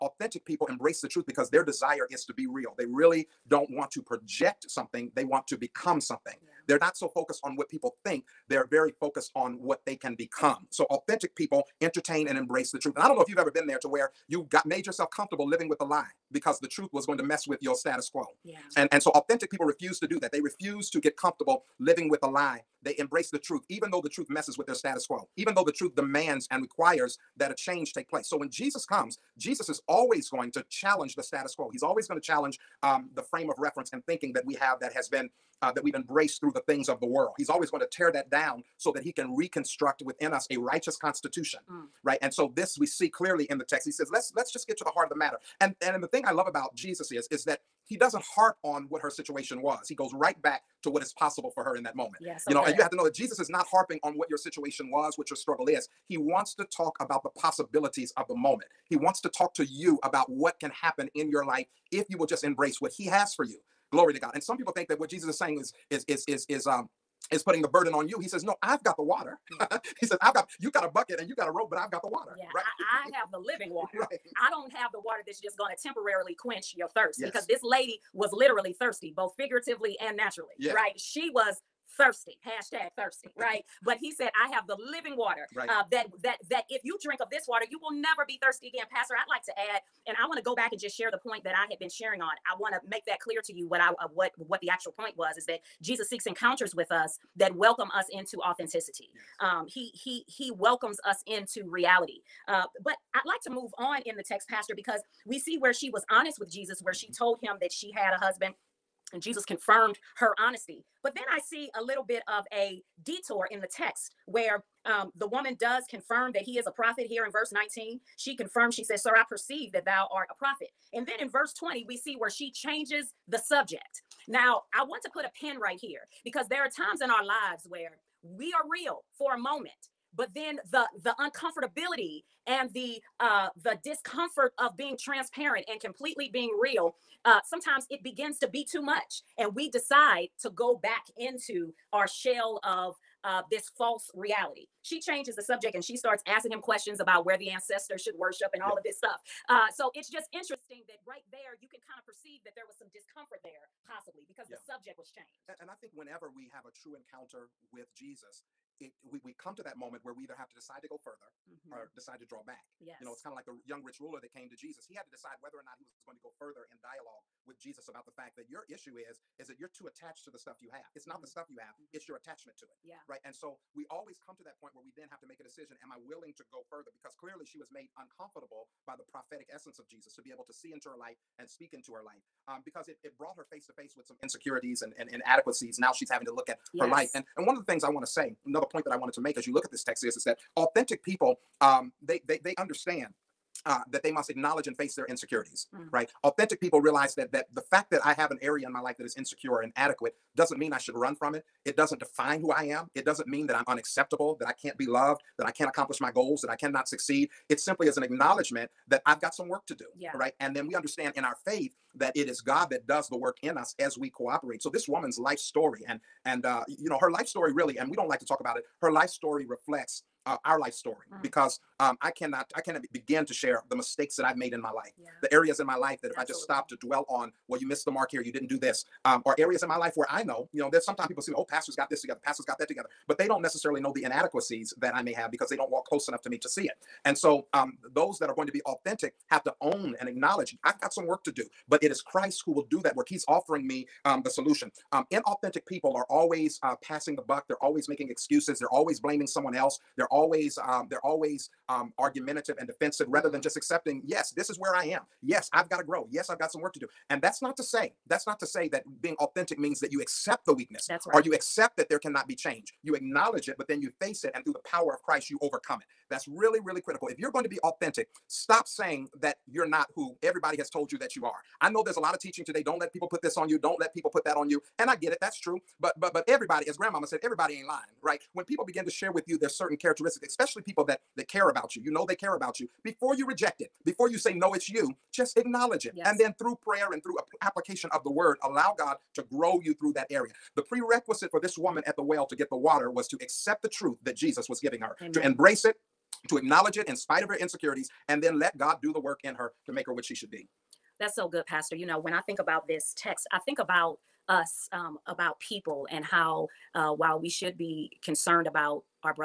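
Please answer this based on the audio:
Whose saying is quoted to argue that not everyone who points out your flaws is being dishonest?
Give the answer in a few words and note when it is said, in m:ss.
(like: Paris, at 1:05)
Grandmama, at 4:36.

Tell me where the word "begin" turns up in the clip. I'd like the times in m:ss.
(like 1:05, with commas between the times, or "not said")
2:18, 3:42, 4:38.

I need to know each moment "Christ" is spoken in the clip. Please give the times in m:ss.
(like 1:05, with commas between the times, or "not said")
4:01, 4:25.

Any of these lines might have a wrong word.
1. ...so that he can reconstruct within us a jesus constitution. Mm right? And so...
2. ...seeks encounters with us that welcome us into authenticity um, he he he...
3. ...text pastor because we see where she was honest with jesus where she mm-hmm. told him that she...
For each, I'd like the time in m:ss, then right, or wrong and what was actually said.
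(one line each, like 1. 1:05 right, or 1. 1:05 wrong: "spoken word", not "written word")
1. 0:38 wrong: "righteous", not "jesus"
2. 1:36 right
3. 1:44 right.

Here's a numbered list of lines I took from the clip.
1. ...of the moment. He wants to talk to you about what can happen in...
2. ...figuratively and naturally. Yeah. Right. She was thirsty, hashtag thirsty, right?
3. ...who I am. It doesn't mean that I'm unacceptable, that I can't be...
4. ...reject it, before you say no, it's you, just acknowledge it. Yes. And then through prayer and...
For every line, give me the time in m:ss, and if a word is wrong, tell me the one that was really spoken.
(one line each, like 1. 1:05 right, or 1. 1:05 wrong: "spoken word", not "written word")
1. 0:58 right
2. 1:19 right
3. 3:22 right
4. 4:43 right.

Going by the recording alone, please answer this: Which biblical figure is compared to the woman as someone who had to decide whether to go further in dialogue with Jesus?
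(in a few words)
The young rich ruler.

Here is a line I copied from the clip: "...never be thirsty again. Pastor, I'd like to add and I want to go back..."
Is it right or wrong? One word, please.
right.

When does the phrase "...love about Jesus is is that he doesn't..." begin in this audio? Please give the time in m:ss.
0:46.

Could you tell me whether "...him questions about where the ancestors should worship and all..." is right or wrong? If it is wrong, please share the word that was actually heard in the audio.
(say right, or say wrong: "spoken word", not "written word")
right.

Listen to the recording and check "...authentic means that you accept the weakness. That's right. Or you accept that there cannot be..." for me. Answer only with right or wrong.
right.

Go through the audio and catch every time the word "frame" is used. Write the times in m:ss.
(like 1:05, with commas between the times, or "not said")
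0:33.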